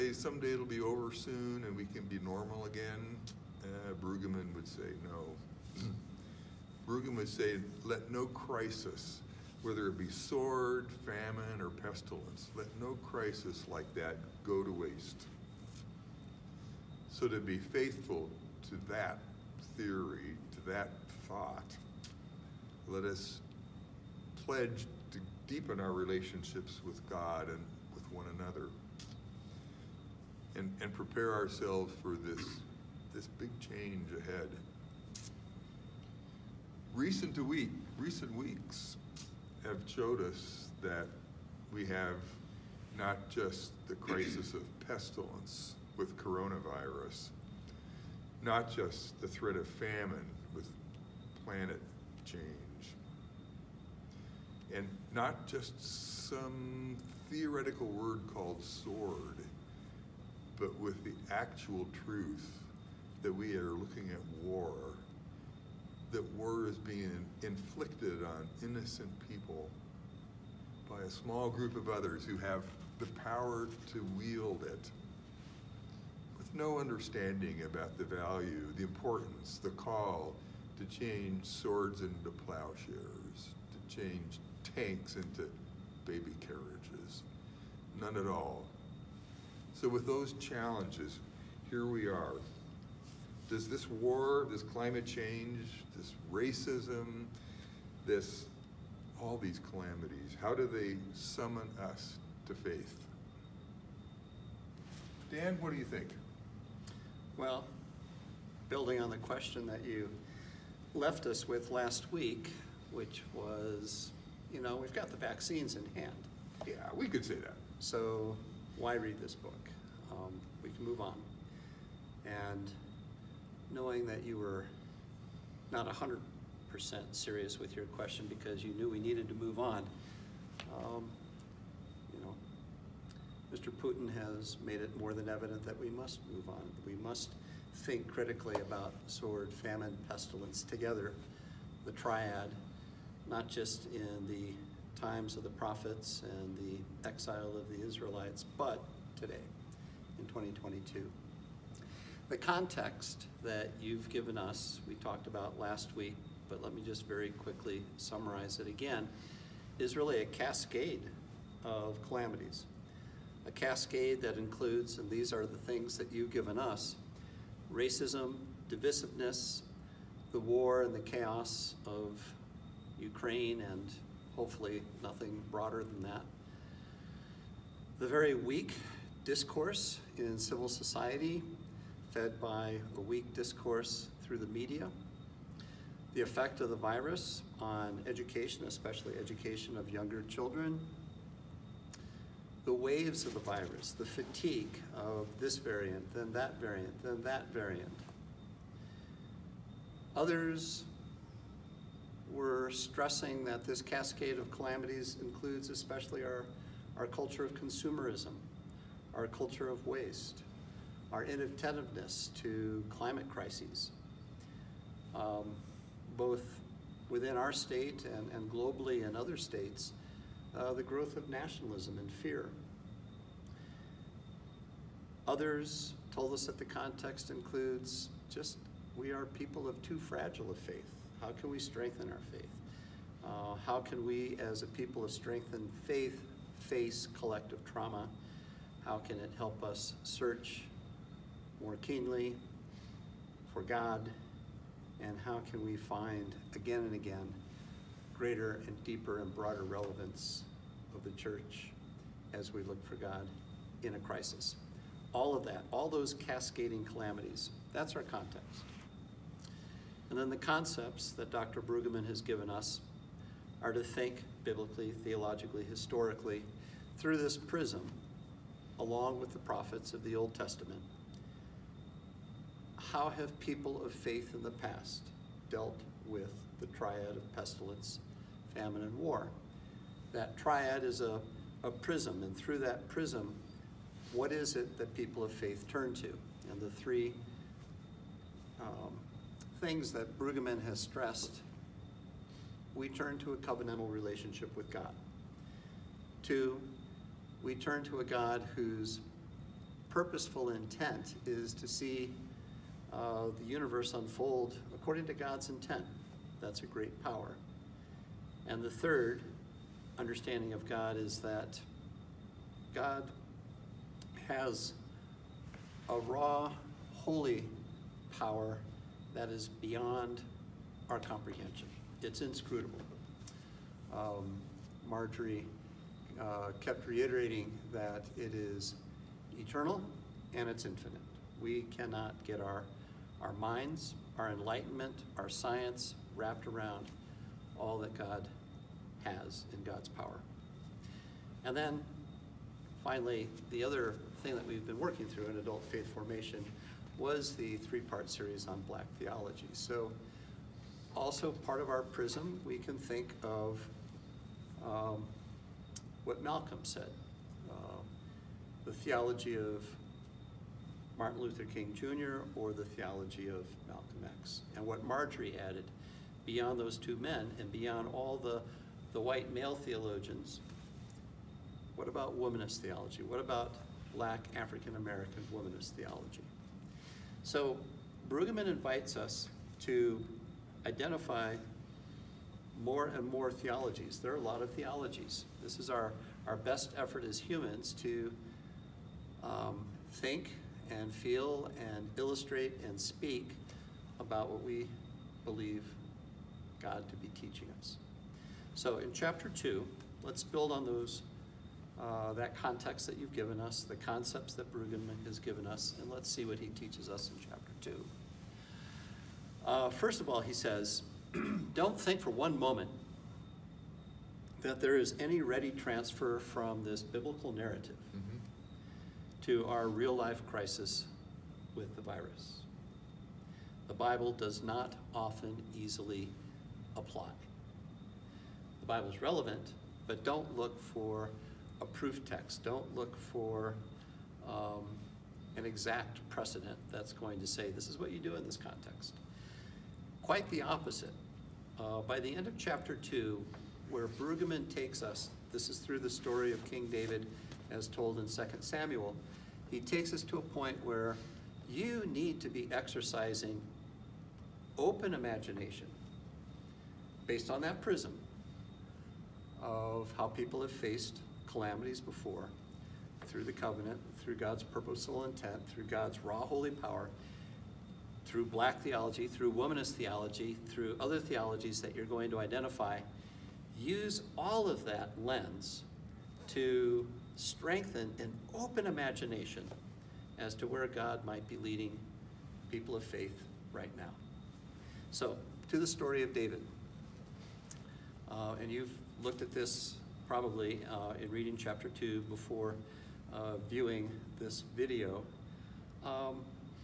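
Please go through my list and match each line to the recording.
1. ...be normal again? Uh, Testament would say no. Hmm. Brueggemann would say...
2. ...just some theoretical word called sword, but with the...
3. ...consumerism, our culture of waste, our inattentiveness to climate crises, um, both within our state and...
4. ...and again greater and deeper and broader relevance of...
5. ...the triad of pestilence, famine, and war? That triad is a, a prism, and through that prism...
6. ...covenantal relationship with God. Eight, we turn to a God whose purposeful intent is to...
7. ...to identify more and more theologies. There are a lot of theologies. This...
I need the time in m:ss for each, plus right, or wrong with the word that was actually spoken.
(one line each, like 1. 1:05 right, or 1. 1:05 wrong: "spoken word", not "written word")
1. 0:02 wrong: "Brueggemann", not "Testament"
2. 0:55 right
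3. 3:27 right
4. 4:06 right
5. 4:36 right
6. 4:53 wrong: "Two", not "Eight"
7. 6:19 right.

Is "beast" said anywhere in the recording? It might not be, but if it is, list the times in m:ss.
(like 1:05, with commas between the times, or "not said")
not said.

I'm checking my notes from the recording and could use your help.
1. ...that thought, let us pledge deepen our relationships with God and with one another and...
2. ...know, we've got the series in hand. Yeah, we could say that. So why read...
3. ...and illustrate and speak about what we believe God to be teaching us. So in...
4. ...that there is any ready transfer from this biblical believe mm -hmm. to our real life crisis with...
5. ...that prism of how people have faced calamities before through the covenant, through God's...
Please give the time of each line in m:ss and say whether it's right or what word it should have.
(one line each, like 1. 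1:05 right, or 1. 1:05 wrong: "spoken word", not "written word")
1. 0:20 right
2. 1:54 wrong: "vaccines", not "series"
3. 6:31 right
4. 6:54 wrong: "narrative", not "believe"
5. 7:37 right.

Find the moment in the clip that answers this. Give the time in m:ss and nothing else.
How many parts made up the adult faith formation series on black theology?
5:47.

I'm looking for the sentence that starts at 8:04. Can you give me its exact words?
So, to the story of David.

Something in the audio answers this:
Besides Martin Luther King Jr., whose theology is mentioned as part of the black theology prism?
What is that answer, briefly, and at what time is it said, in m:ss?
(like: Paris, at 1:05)
Malcolm X, at 6:03.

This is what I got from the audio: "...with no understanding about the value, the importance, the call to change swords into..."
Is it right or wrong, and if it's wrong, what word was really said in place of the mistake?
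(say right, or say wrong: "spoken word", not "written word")
right.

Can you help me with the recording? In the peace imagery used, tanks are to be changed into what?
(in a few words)
baby carriages.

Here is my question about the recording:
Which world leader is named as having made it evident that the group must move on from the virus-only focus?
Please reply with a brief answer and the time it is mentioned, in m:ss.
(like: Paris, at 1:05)
Putin, at 2:13.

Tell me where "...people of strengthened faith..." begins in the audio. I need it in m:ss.
3:54.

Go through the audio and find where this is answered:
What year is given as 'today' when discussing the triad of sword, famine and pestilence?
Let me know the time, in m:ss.
2:30.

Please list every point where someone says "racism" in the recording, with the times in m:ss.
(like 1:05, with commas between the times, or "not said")
1:36, 2:47.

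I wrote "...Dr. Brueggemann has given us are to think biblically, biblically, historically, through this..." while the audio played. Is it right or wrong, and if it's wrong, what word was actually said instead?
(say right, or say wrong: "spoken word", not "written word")
wrong: "theologically", not "biblically".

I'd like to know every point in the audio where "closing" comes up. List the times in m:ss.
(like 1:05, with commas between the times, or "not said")
not said.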